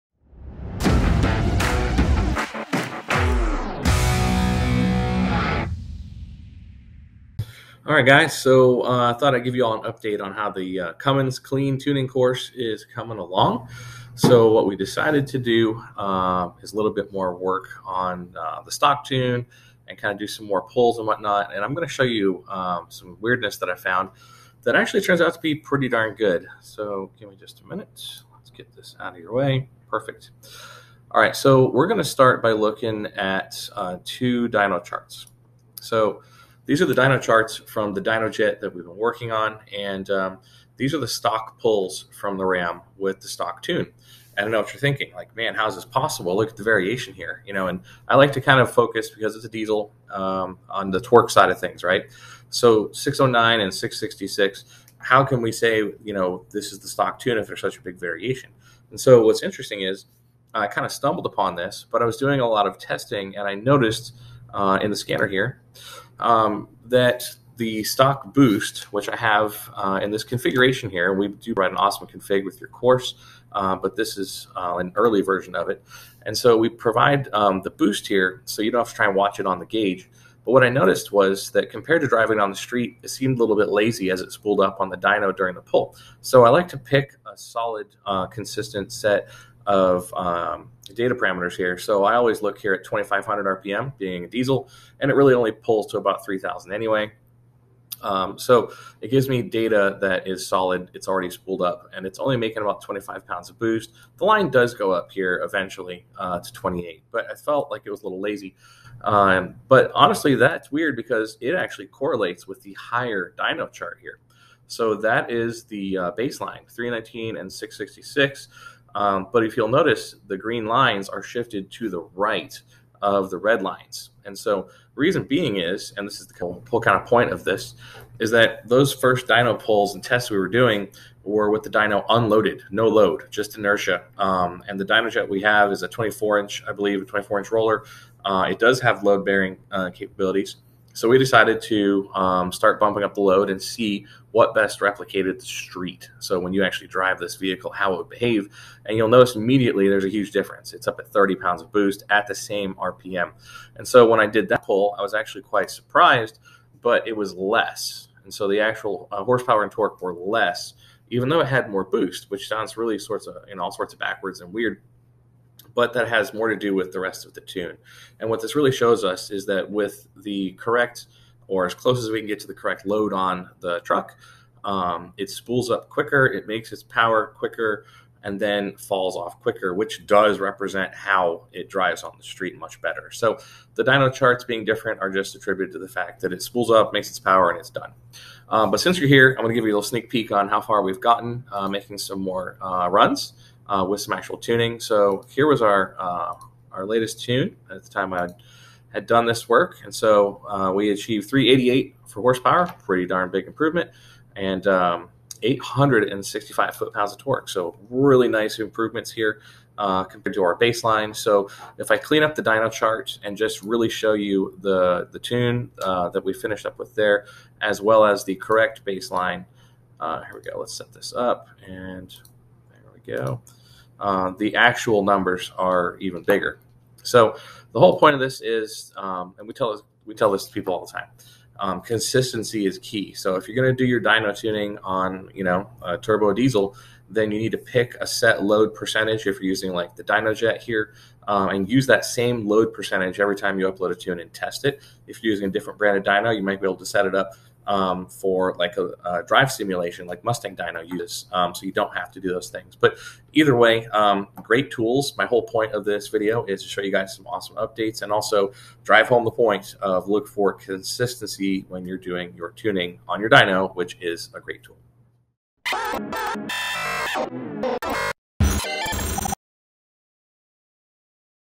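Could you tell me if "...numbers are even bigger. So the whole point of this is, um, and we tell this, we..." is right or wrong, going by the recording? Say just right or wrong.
right.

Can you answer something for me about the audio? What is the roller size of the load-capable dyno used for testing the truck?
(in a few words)
24 inch.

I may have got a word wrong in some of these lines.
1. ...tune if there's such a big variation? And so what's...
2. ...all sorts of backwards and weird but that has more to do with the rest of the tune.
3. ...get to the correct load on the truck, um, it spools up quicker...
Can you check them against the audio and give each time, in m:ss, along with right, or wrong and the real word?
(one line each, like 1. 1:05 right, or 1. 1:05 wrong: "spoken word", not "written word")
1. 0:57 right
2. 2:43 right
3. 2:52 right.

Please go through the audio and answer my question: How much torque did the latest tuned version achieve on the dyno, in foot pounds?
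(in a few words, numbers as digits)
865.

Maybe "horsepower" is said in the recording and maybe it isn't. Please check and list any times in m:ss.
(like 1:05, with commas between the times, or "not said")
2:39, 3:22.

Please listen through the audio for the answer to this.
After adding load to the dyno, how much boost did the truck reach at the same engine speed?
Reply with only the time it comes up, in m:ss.
2:31.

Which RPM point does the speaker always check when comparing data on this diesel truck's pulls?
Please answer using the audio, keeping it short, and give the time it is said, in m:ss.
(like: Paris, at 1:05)
2,500 RPM, at 1:32.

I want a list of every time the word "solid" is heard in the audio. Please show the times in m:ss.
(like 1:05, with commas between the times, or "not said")
1:27, 1:40.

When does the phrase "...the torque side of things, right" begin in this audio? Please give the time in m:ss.
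0:50.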